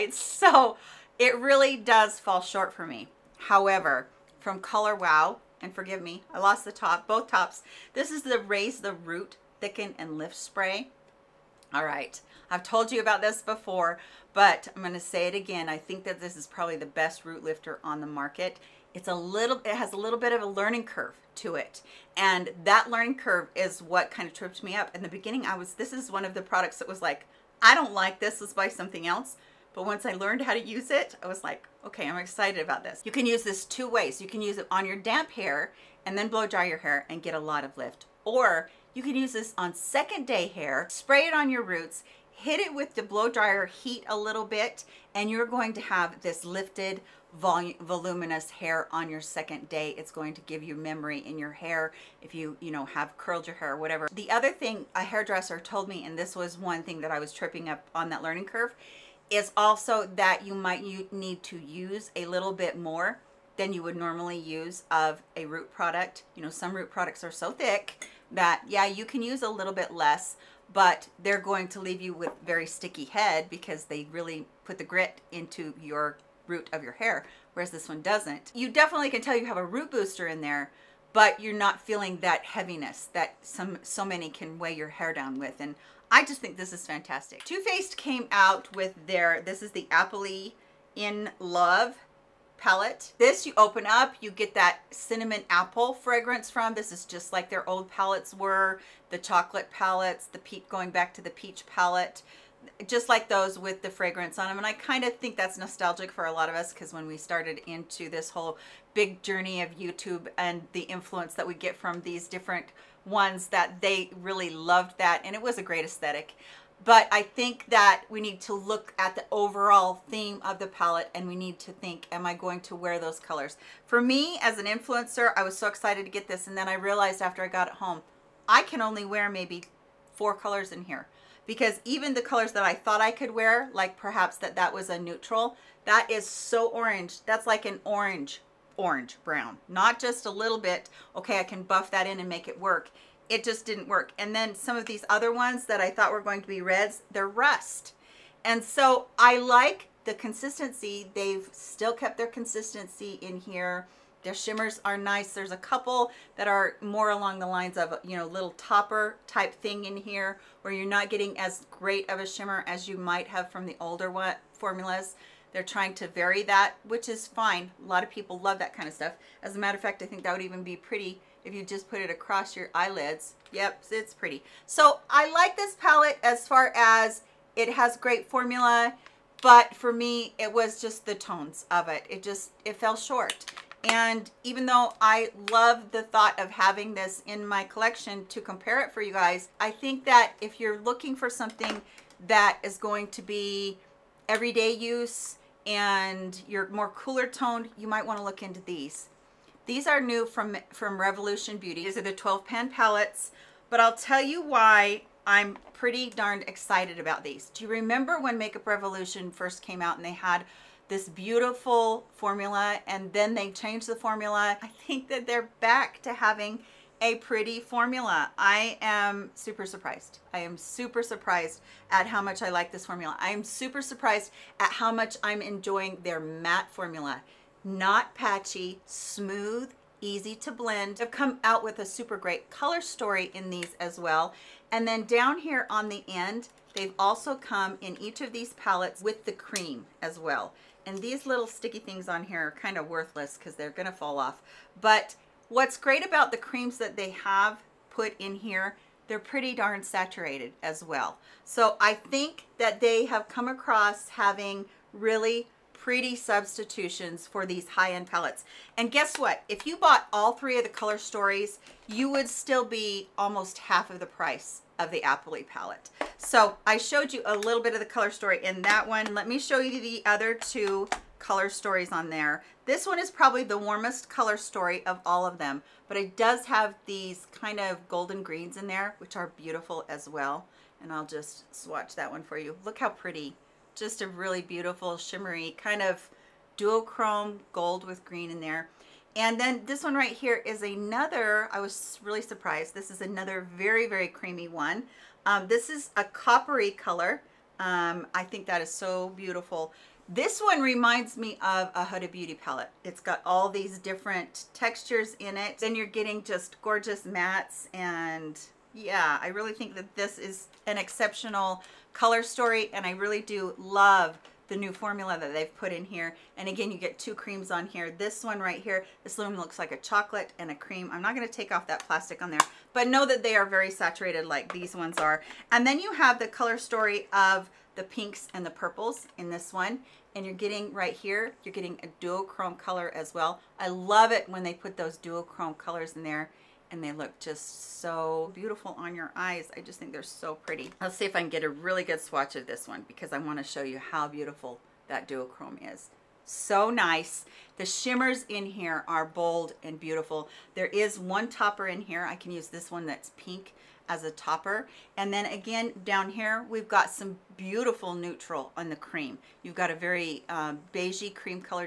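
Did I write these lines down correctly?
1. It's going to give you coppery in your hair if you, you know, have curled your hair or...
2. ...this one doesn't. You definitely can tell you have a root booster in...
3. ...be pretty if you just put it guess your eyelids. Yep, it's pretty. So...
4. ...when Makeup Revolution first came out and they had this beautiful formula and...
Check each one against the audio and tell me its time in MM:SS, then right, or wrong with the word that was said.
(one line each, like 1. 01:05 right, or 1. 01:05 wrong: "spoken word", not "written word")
1. 00:49 wrong: "memory", not "coppery"
2. 01:17 right
3. 02:50 wrong: "across", not "guess"
4. 03:28 right.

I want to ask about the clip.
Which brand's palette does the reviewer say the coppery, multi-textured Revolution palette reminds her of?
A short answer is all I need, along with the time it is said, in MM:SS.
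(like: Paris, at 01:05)
Huda Beauty, at 05:01.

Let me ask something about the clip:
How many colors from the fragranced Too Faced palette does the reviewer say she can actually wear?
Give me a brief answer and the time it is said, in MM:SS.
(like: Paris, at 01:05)
4, at 02:10.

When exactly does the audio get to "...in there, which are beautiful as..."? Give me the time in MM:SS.
04:38.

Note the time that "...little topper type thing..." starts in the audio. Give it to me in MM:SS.
02:38.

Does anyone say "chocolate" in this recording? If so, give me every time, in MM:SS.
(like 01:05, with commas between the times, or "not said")
01:39, 05:19.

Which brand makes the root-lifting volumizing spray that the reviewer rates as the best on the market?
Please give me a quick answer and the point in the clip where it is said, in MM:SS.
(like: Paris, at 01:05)
Color Wow, at 00:04.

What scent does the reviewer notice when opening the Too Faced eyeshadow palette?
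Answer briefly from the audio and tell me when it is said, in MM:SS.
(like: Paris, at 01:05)
cinnamon apple, at 01:34.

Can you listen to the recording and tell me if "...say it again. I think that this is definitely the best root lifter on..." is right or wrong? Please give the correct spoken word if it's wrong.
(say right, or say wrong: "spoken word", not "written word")
wrong: "probably", not "definitely".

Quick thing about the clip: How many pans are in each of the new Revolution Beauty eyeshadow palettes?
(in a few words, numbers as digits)
12.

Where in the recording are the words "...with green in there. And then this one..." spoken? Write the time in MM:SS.
04:47.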